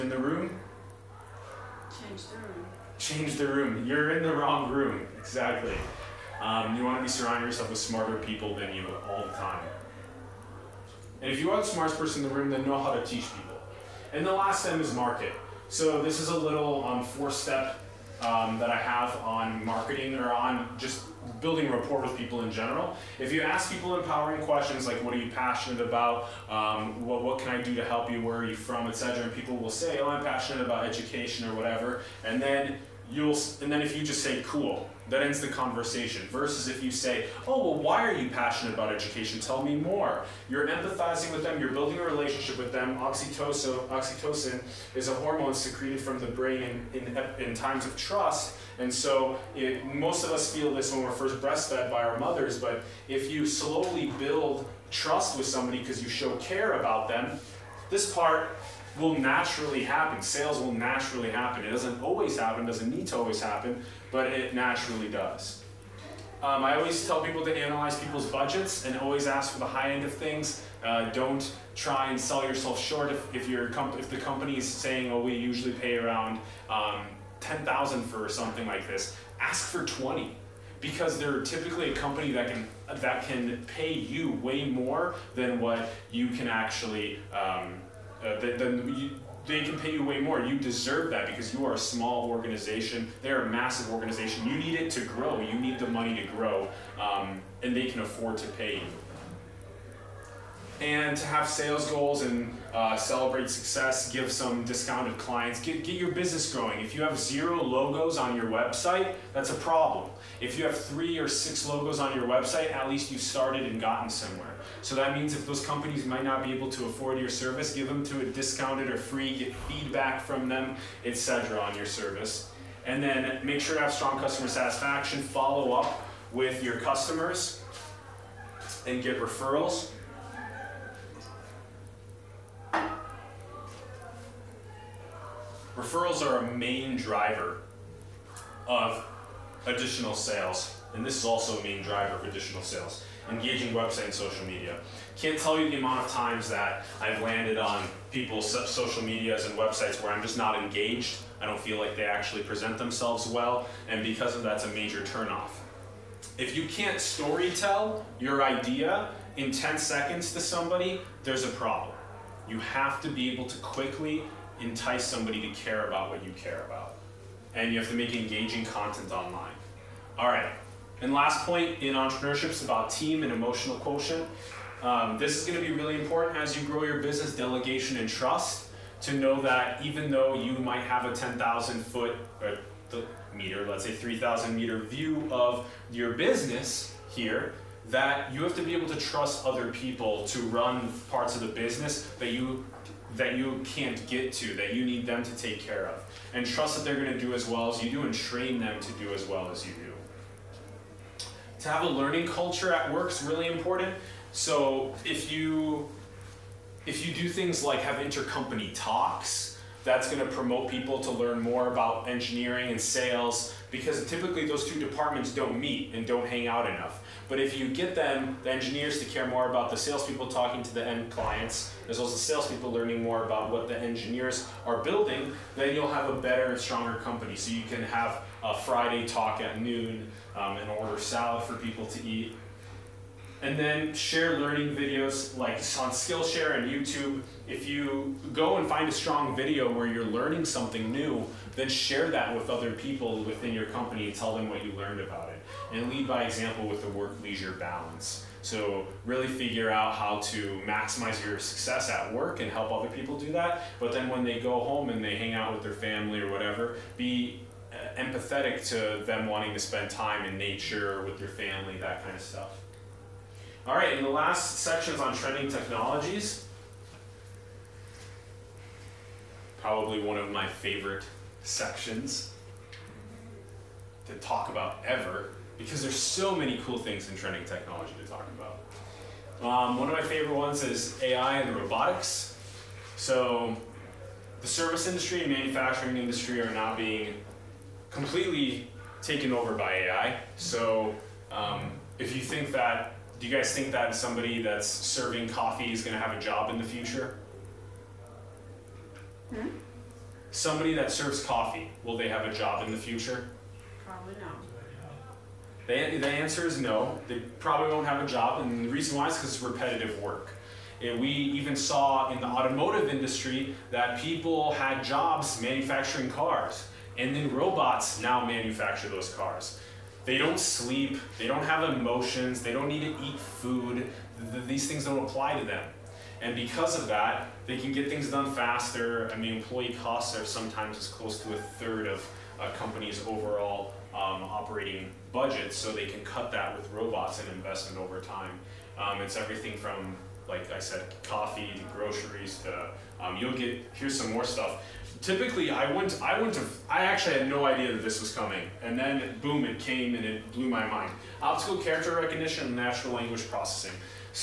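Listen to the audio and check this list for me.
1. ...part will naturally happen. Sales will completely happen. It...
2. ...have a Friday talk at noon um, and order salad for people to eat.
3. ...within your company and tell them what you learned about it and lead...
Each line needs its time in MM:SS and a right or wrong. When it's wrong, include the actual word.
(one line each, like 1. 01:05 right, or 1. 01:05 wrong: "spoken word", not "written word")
1. 00:58 wrong: "naturally", not "completely"
2. 03:47 right
3. 04:03 right.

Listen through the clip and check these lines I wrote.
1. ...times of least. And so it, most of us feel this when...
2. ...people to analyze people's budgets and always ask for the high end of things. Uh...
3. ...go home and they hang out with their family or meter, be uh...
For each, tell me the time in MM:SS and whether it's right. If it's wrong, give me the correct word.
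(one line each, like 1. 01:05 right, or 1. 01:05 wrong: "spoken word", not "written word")
1. 00:47 wrong: "trust", not "least"
2. 01:07 right
3. 04:14 wrong: "whatever", not "meter".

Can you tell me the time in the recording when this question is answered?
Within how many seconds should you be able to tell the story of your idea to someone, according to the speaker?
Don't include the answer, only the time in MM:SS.
02:39.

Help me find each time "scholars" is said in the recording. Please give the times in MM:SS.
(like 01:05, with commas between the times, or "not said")
not said.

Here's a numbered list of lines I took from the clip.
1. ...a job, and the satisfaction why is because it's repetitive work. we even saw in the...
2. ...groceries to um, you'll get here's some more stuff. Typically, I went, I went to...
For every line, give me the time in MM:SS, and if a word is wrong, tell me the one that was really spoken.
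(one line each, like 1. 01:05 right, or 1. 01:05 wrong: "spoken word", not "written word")
1. 05:08 wrong: "reason", not "satisfaction"
2. 05:41 right.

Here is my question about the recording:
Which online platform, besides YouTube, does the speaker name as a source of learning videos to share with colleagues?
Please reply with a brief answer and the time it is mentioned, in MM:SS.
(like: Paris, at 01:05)
Skillshare, at 03:55.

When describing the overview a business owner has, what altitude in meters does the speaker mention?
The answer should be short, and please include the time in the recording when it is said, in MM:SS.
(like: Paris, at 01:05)
3,000 meters, at 03:03.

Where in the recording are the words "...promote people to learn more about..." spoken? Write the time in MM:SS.
03:30.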